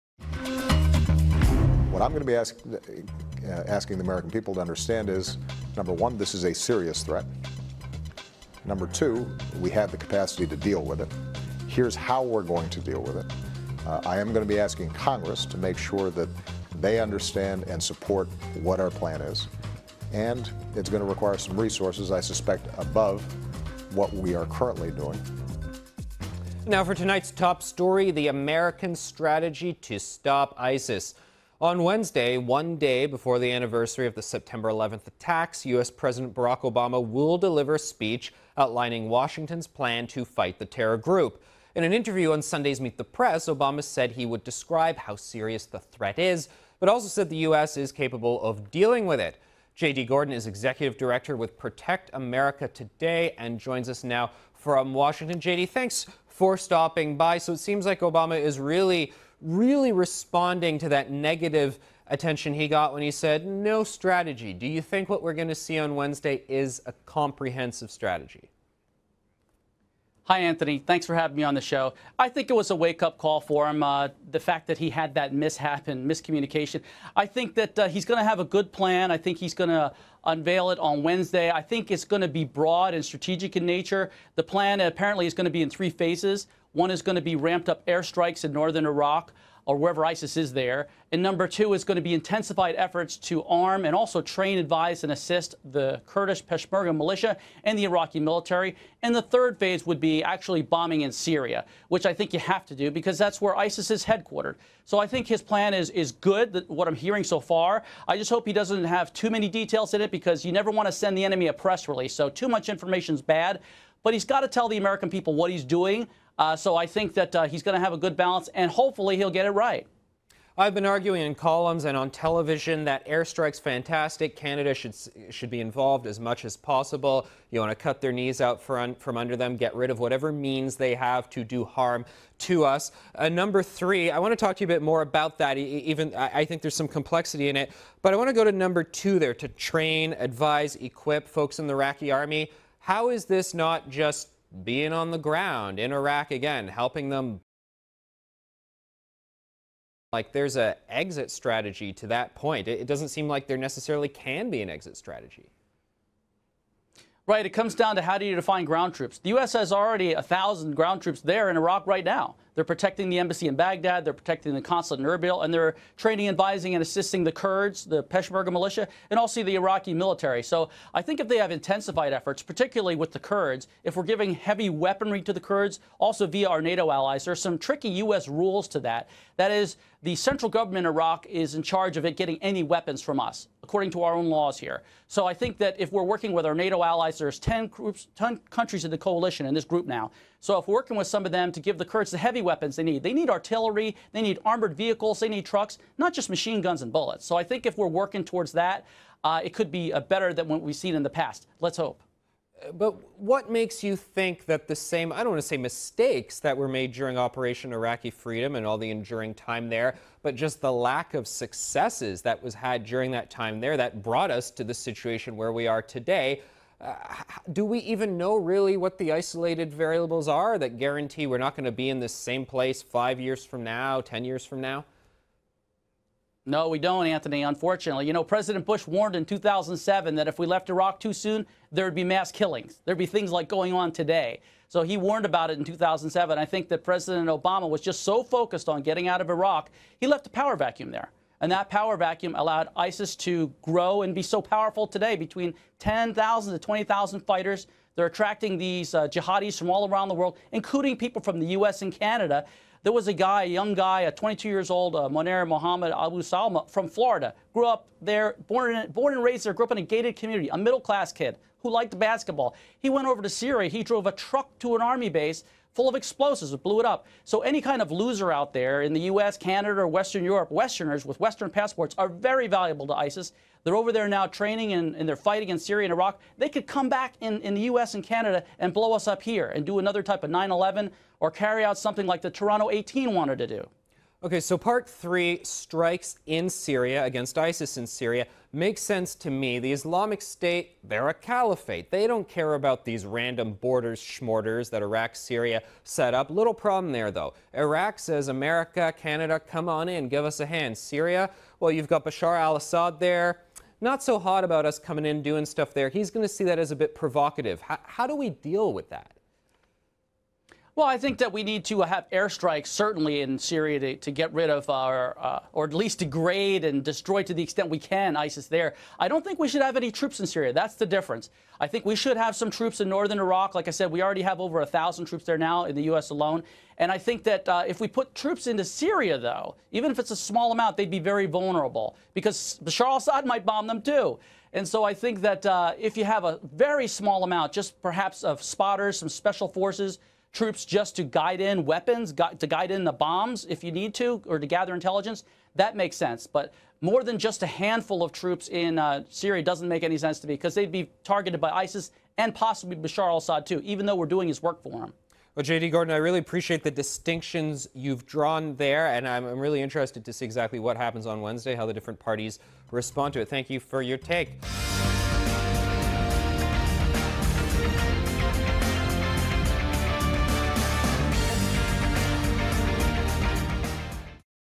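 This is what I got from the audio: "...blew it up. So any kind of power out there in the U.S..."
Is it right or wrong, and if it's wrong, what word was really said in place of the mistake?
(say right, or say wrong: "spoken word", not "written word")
wrong: "loser", not "power".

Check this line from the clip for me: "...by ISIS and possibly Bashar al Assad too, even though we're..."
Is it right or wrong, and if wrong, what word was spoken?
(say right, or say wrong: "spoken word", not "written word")
right.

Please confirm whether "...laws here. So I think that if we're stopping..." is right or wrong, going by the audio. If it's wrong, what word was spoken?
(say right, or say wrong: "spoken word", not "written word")
wrong: "working", not "stopping".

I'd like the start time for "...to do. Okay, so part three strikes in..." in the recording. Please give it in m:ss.
4:43.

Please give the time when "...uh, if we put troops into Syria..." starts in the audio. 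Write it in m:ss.
5:27.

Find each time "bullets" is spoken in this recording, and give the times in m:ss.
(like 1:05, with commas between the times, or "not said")
3:16.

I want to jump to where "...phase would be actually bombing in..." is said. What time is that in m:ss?
1:39.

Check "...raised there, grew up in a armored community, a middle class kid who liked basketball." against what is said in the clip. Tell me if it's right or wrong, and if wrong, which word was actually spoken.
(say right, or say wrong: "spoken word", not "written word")
wrong: "gated", not "armored".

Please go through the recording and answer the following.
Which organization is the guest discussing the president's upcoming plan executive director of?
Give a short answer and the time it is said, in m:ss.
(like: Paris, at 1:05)
Protect America Today, at 0:51.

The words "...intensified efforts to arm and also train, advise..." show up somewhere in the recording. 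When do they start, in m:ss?
1:32.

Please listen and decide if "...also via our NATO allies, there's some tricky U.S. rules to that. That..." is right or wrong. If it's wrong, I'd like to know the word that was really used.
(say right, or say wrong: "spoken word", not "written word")
right.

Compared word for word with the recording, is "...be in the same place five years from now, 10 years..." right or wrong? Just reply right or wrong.
right.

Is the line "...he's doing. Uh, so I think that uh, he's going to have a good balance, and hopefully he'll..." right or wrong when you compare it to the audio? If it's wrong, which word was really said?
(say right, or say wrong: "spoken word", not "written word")
right.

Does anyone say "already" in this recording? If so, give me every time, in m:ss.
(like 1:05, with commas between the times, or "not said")
2:39, 5:24.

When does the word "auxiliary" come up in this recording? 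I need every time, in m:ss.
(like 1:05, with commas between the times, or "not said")
not said.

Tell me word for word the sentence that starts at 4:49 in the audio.
The Islamic State, they're a caliphate.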